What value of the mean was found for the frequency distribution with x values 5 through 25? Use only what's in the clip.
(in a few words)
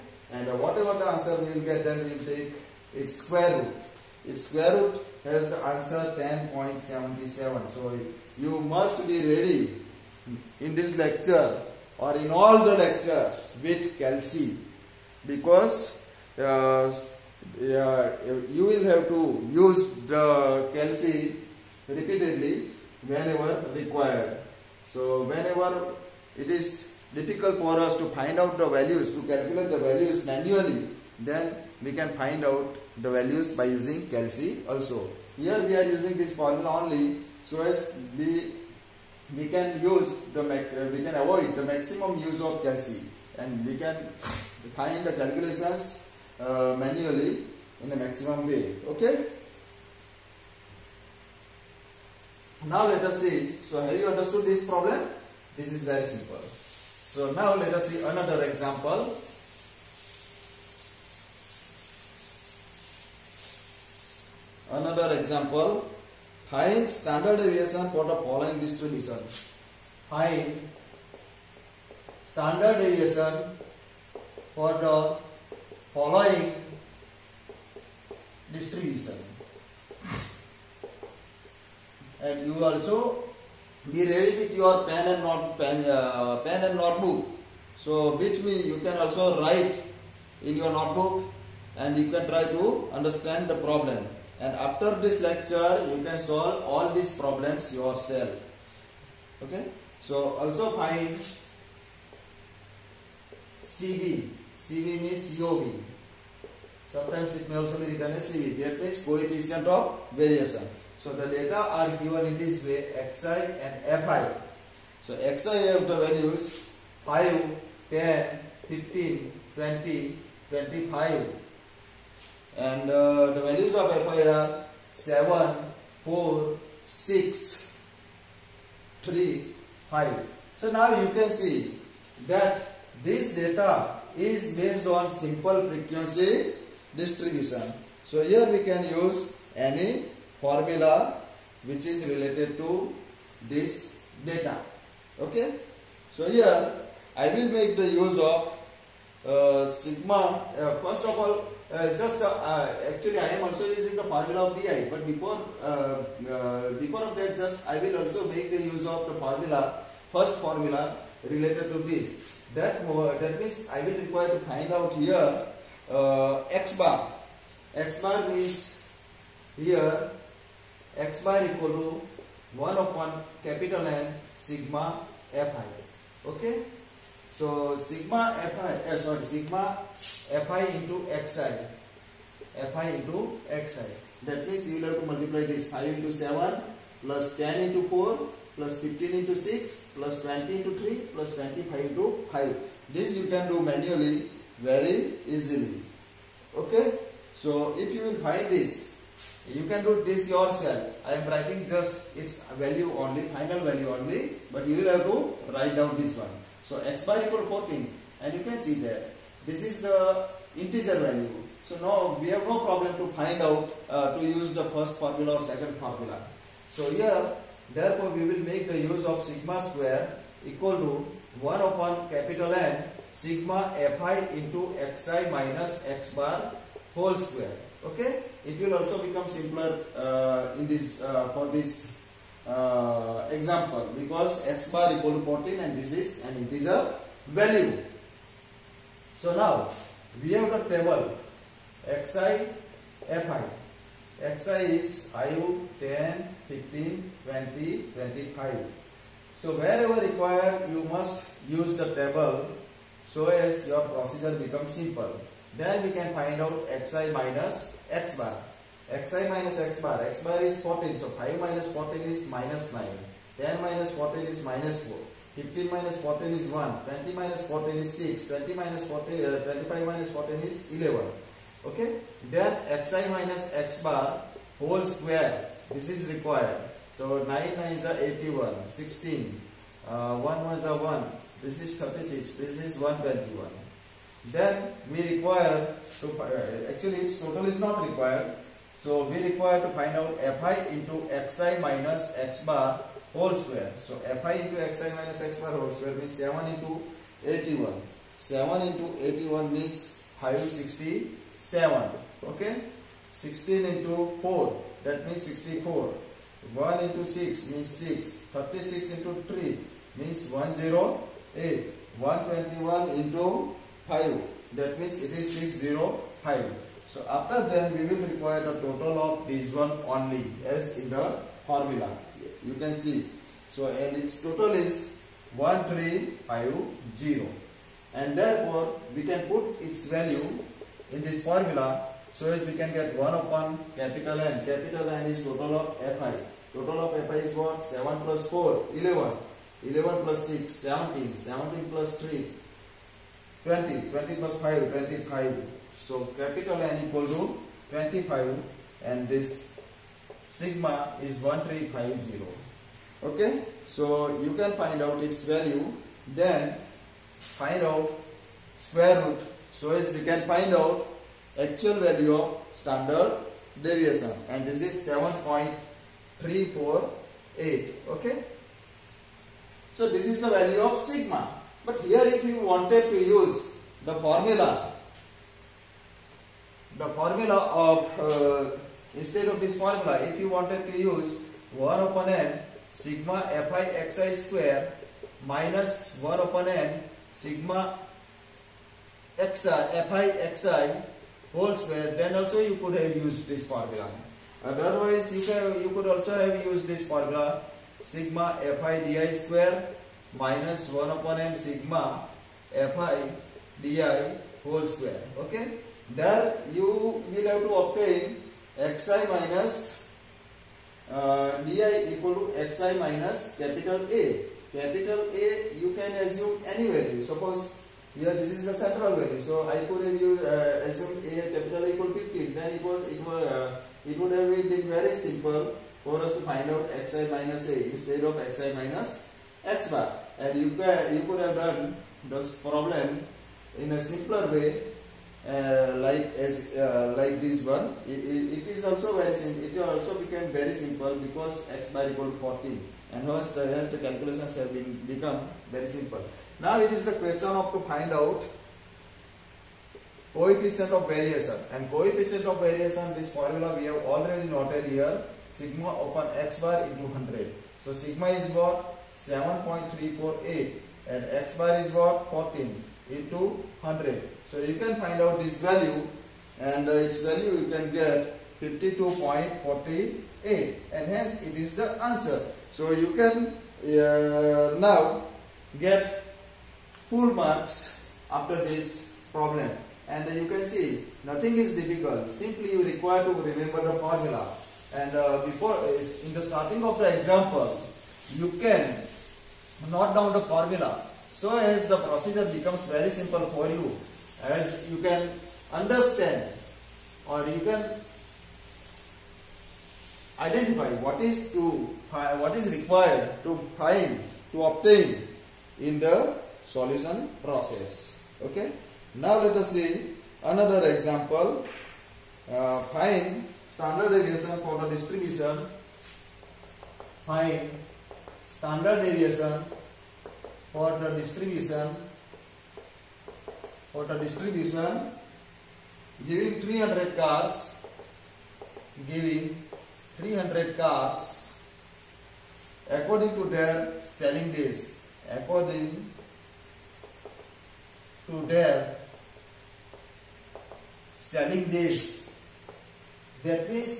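14.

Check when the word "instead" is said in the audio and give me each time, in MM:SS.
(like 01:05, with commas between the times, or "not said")
06:18, 07:07.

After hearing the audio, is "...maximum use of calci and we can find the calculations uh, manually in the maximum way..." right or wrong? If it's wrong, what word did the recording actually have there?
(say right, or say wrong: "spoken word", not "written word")
right.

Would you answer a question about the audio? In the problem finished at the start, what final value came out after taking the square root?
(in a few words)
10.77.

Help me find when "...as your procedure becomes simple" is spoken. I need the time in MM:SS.
04:13.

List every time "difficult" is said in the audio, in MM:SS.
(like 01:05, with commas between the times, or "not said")
00:27, 08:01.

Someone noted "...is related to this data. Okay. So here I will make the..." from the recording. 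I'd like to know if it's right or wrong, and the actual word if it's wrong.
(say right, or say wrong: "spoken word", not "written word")
right.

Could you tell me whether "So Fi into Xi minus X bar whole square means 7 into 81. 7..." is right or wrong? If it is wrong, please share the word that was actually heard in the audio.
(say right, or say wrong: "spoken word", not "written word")
right.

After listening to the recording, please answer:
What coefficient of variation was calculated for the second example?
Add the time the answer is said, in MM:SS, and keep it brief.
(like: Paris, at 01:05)
52.48, at 07:48.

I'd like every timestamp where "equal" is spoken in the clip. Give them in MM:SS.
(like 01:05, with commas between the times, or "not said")
02:51, 03:27, 03:40, 03:54, 05:46, 06:51, 07:01, 07:21.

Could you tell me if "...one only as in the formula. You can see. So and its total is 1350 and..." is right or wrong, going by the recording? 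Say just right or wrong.
right.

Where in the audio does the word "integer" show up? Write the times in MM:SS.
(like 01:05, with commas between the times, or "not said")
03:30, 03:56.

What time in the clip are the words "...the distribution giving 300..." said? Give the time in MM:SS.
08:43.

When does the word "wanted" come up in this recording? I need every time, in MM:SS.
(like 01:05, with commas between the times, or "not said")
06:12, 06:20.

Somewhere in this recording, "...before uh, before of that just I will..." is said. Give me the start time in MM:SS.
02:35.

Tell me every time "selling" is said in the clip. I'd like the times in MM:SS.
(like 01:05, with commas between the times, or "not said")
08:53, 09:00.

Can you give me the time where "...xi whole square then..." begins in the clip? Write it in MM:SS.
06:30.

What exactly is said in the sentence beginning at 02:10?
So now you can see that this data is based on simple frequency distribution.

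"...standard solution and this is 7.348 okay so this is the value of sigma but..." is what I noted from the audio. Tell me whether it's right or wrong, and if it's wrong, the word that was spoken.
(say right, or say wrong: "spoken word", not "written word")
wrong: "deviation", not "solution".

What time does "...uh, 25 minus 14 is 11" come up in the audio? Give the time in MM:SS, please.
04:29.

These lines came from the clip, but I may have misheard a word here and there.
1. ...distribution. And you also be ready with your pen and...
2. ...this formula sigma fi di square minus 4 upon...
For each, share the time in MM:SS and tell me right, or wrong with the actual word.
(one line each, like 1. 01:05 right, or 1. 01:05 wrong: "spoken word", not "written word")
1. 01:18 right
2. 06:36 wrong: "1", not "4".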